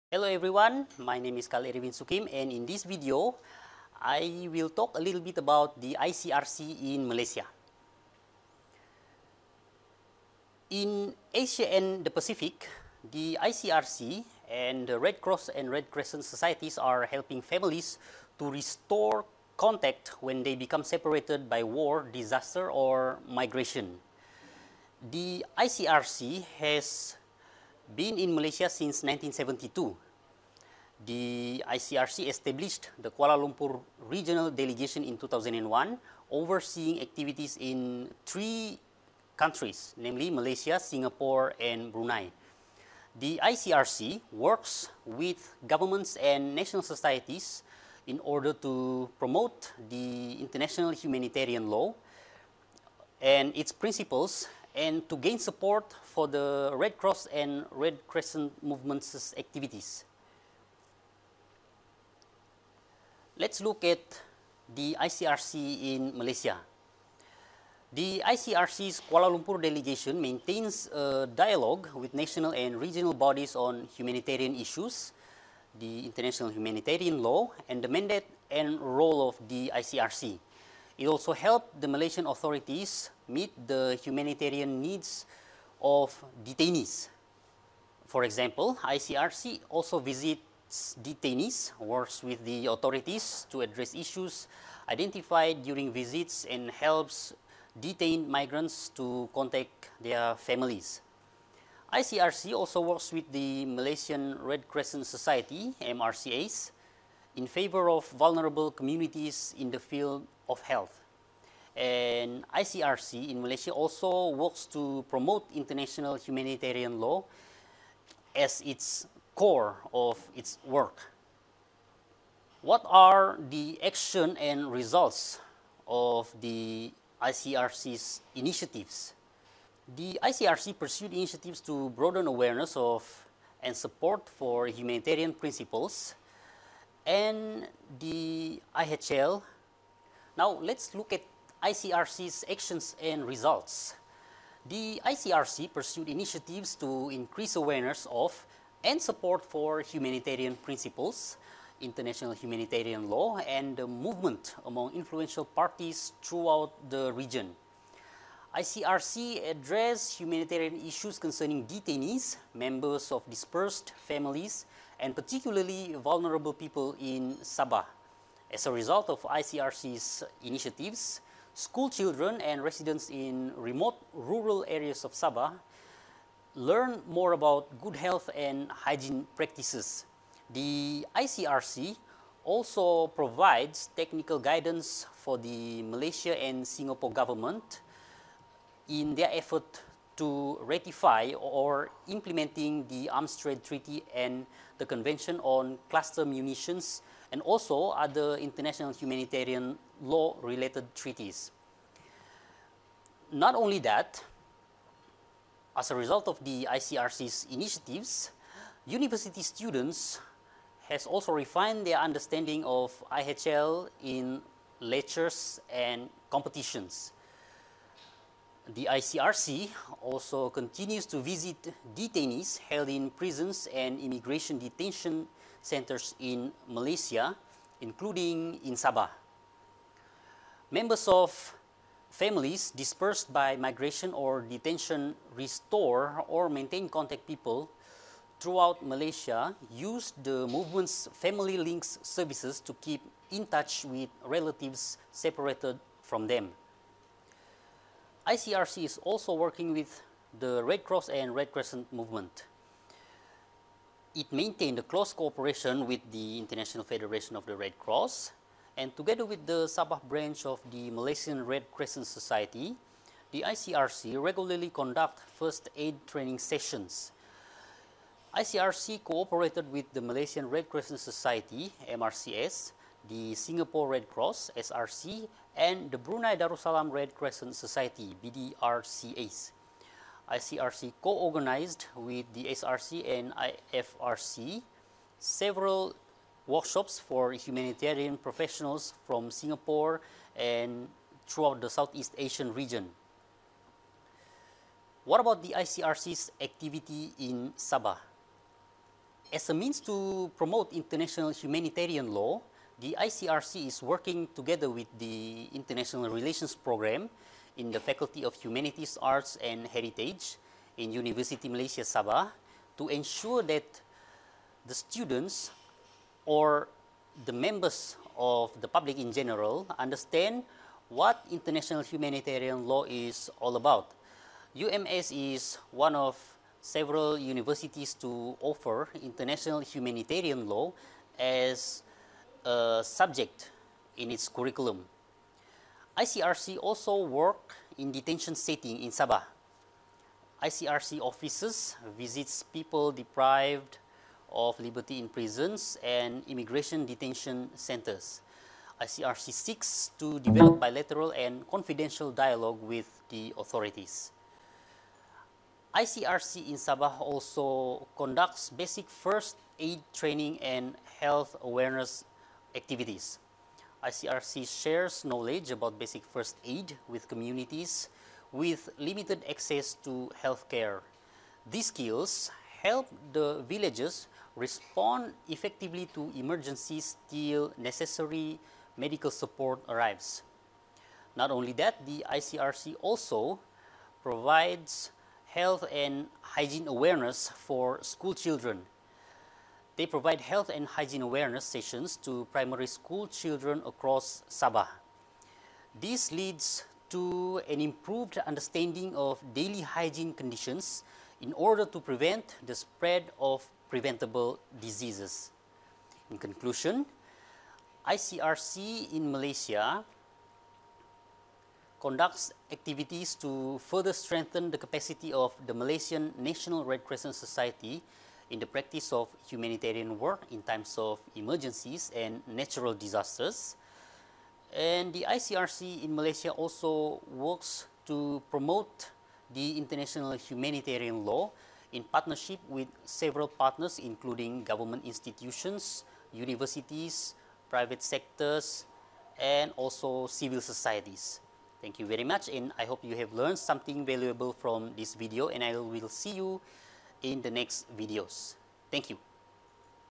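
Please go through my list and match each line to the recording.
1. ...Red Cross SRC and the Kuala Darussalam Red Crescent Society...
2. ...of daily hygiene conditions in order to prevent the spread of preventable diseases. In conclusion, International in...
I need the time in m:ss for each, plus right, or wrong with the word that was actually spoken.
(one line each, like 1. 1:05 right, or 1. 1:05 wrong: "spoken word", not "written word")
1. 4:33 wrong: "Brunei", not "Kuala"
2. 6:38 wrong: "ICRC", not "International".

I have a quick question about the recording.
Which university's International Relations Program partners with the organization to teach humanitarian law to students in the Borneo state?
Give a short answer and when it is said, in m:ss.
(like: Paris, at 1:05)
University Malaysia Sabah, at 5:10.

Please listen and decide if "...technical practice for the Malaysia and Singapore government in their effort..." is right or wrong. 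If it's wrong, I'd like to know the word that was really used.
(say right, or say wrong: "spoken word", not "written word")
wrong: "guidance", not "practice".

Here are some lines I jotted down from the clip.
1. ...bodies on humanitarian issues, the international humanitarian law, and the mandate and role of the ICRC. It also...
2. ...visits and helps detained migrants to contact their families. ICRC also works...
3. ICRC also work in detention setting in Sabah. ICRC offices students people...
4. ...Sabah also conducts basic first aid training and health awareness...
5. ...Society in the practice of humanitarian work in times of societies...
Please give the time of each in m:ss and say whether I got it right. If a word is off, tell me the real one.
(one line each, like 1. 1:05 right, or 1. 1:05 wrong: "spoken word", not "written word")
1. 1:13 right
2. 1:35 right
3. 5:35 wrong: "visits", not "students"
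4. 5:56 right
5. 6:57 wrong: "emergencies", not "societies".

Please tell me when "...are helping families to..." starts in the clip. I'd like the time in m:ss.
0:16.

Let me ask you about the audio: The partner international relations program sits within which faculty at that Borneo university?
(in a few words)
Faculty of Humanities, Arts and Heritage.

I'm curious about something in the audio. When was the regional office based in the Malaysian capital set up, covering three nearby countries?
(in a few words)
2001.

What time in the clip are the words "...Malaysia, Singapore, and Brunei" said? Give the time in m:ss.
0:40.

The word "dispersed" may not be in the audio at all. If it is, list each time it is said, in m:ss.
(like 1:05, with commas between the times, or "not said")
2:43, 3:52.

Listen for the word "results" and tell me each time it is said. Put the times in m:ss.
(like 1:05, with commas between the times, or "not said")
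2:04, 2:23, 2:48, 3:25.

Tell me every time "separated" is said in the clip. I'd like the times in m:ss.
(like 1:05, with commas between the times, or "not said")
0:20, 4:05.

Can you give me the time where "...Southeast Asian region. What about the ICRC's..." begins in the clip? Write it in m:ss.
4:51.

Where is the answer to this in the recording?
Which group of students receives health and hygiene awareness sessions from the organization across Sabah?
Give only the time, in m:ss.
6:32.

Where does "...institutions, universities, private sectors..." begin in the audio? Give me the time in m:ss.
7:14.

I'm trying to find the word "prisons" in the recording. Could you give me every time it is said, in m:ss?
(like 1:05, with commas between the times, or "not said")
3:43, 5:45.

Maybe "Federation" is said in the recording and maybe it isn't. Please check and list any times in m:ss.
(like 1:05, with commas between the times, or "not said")
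4:16.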